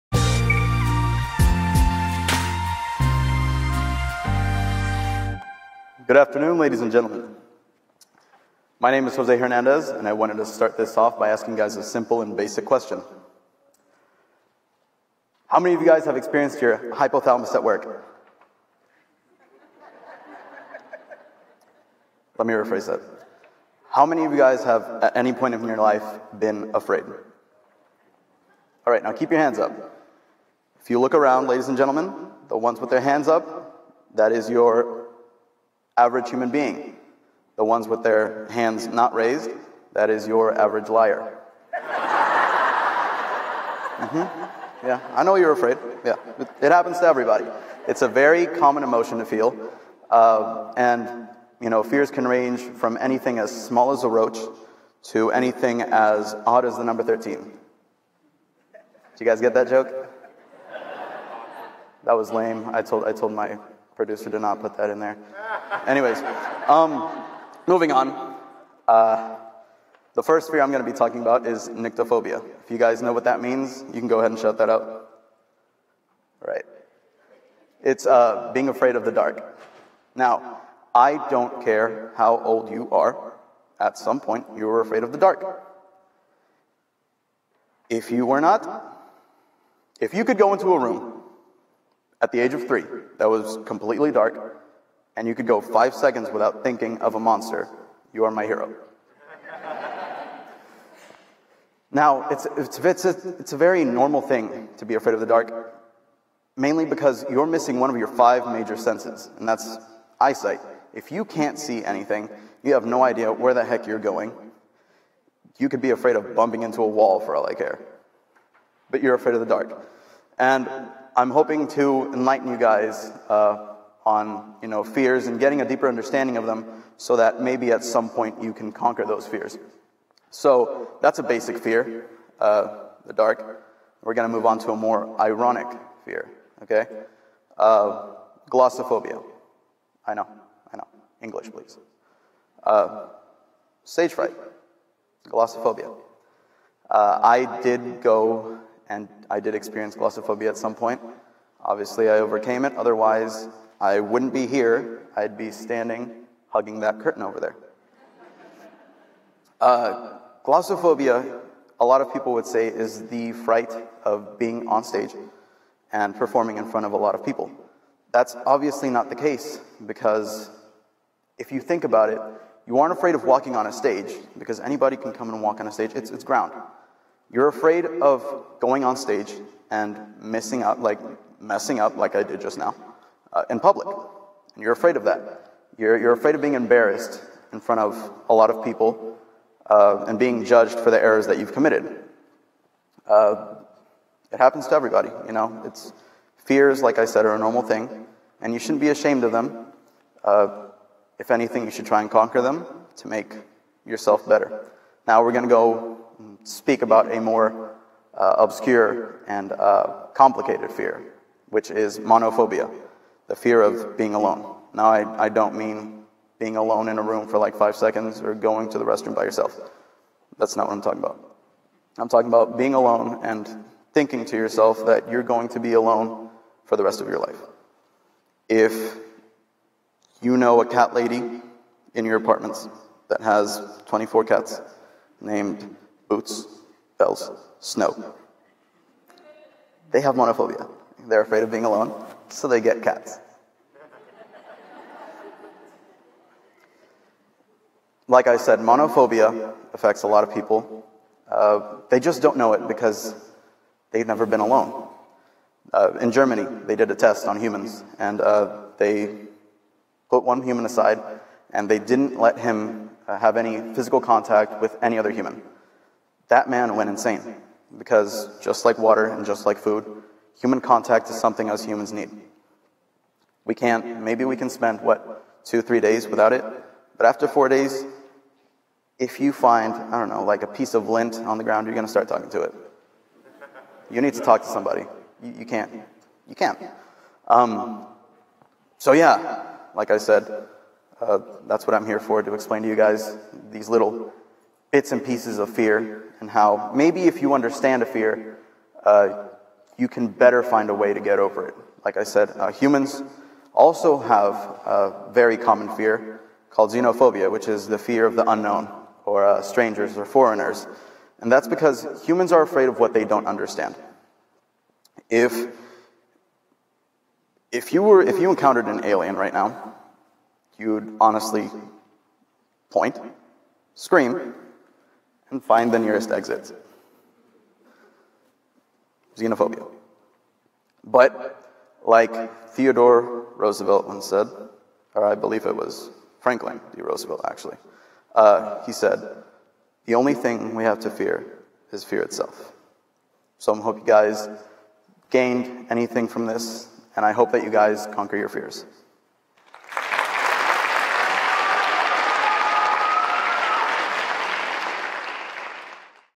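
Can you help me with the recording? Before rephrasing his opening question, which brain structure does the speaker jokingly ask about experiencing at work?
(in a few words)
hypothalamus.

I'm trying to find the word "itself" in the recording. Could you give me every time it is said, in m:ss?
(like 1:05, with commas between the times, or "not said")
5:42.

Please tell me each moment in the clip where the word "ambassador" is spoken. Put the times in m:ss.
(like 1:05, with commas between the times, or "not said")
not said.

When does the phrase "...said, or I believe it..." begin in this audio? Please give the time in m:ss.
5:34.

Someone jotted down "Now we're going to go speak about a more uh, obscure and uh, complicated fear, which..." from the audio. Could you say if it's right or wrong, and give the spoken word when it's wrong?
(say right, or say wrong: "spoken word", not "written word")
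right.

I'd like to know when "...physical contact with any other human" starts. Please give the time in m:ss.
4:23.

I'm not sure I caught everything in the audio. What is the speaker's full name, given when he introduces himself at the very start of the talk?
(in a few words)
Jose Hernandez.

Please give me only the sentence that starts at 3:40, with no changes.
That's not what I'm talking about.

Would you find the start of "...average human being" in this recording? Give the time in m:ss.
0:35.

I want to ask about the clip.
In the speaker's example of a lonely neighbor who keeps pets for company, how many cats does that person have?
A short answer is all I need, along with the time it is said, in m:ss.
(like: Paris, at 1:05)
24, at 3:53.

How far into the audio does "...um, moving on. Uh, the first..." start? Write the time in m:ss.
1:06.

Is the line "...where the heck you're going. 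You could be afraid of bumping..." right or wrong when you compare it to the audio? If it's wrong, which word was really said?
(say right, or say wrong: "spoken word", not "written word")
right.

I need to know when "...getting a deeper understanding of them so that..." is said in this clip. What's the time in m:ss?
2:05.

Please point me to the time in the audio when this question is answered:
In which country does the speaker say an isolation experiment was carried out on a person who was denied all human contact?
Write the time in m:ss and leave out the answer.
4:16.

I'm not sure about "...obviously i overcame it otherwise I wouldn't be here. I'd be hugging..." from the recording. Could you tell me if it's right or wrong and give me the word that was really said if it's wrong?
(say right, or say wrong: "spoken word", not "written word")
wrong: "standing", not "hugging".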